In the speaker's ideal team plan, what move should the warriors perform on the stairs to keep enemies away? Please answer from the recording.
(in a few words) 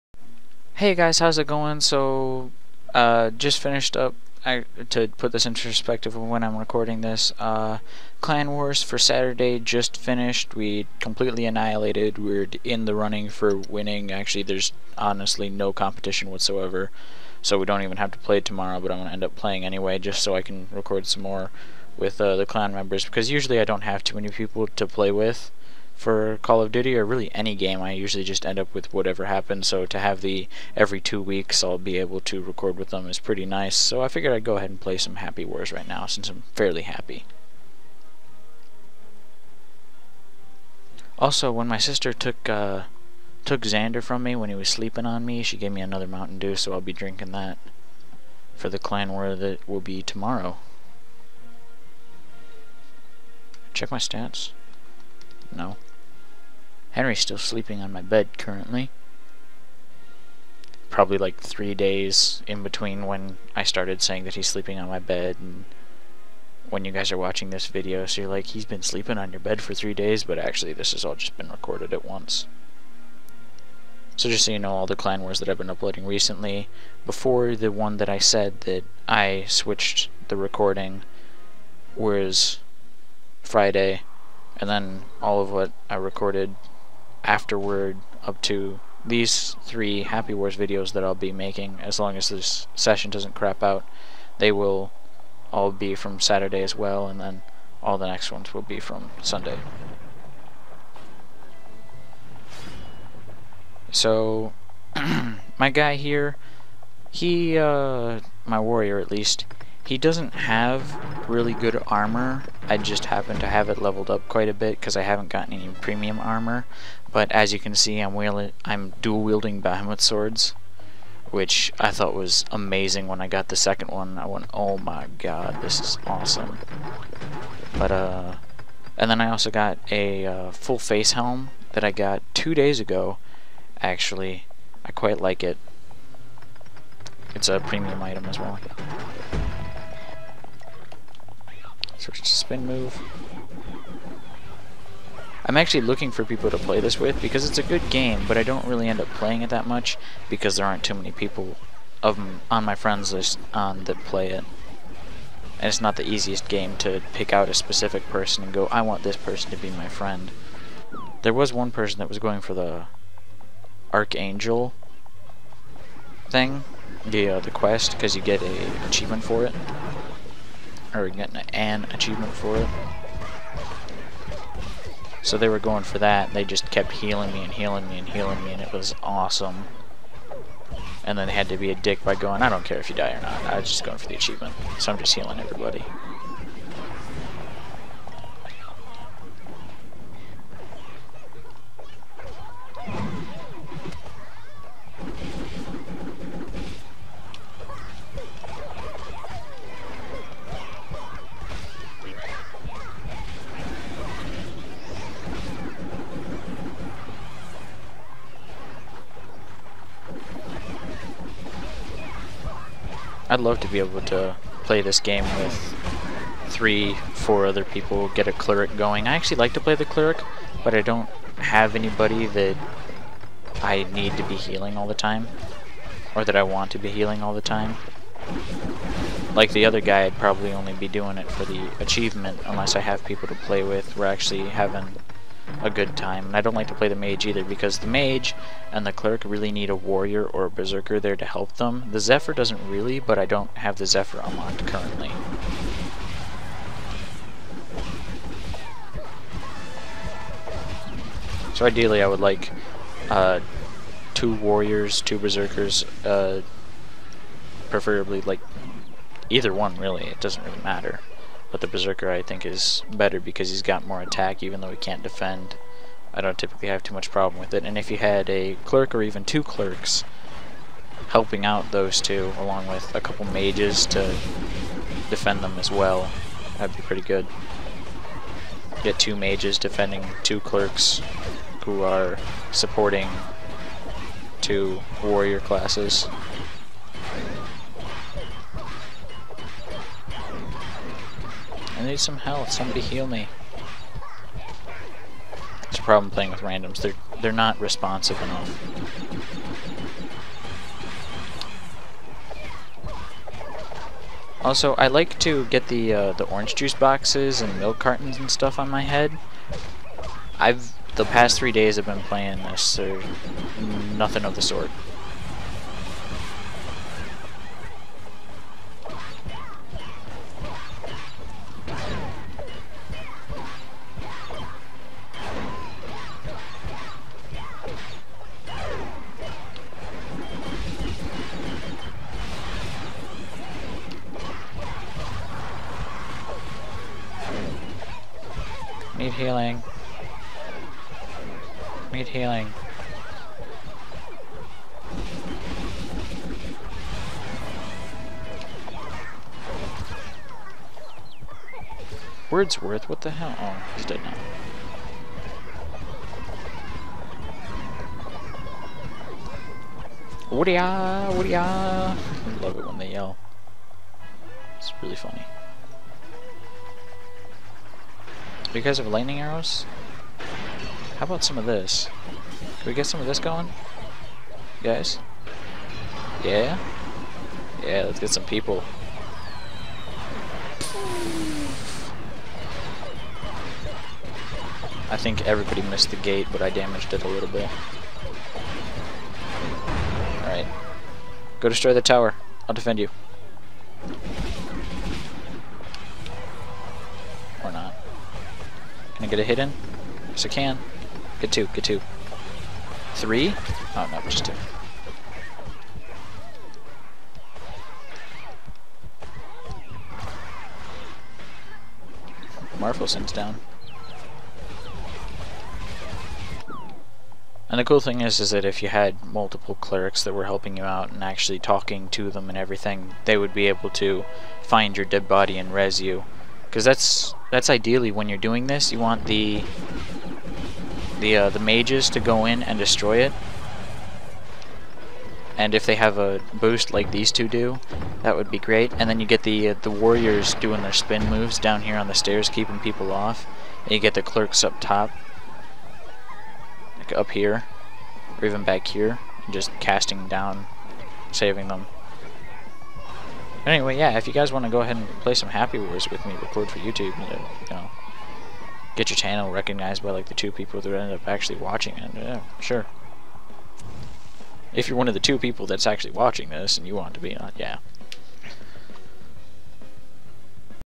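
spin moves.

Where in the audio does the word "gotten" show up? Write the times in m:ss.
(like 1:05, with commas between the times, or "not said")
1:55.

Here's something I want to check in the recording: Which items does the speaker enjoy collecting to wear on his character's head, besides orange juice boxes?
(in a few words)
milk cartons.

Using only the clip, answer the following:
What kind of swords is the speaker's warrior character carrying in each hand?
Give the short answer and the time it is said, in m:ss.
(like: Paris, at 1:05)
Bahamut swords, at 1:59.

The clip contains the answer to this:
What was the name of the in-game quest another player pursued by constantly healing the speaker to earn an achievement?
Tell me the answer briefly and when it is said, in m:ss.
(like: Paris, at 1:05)
Archangel, at 2:43.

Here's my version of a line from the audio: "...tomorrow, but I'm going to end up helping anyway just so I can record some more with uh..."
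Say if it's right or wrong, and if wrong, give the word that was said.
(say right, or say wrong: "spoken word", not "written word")
wrong: "playing", not "helping".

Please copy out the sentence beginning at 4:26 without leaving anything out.
I don't typically have too much problem with it.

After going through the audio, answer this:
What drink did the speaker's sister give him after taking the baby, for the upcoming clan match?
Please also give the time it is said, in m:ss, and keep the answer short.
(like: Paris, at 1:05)
Mountain Dew, at 0:46.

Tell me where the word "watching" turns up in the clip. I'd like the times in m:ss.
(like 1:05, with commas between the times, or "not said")
1:07, 7:41, 7:45.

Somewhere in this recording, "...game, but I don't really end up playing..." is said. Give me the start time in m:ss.
2:27.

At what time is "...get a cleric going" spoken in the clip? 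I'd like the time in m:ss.
3:38.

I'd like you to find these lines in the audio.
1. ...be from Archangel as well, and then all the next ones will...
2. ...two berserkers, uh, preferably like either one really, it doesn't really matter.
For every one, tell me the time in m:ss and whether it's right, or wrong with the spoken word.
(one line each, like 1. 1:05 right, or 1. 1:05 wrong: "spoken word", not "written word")
1. 1:35 wrong: "Saturday", not "Archangel"
2. 4:15 right.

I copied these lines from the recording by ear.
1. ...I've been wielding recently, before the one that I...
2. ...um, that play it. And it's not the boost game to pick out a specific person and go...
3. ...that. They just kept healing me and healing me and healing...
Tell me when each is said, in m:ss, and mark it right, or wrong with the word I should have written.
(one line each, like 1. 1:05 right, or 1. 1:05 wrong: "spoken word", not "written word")
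1. 1:15 wrong: "uploading", not "wielding"
2. 2:33 wrong: "easiest", not "boost"
3. 2:55 right.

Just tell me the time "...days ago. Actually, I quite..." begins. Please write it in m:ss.
2:12.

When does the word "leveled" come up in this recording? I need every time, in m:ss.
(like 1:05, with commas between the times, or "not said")
1:53.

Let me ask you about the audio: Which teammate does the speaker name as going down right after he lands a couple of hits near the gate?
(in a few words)
Marfelson.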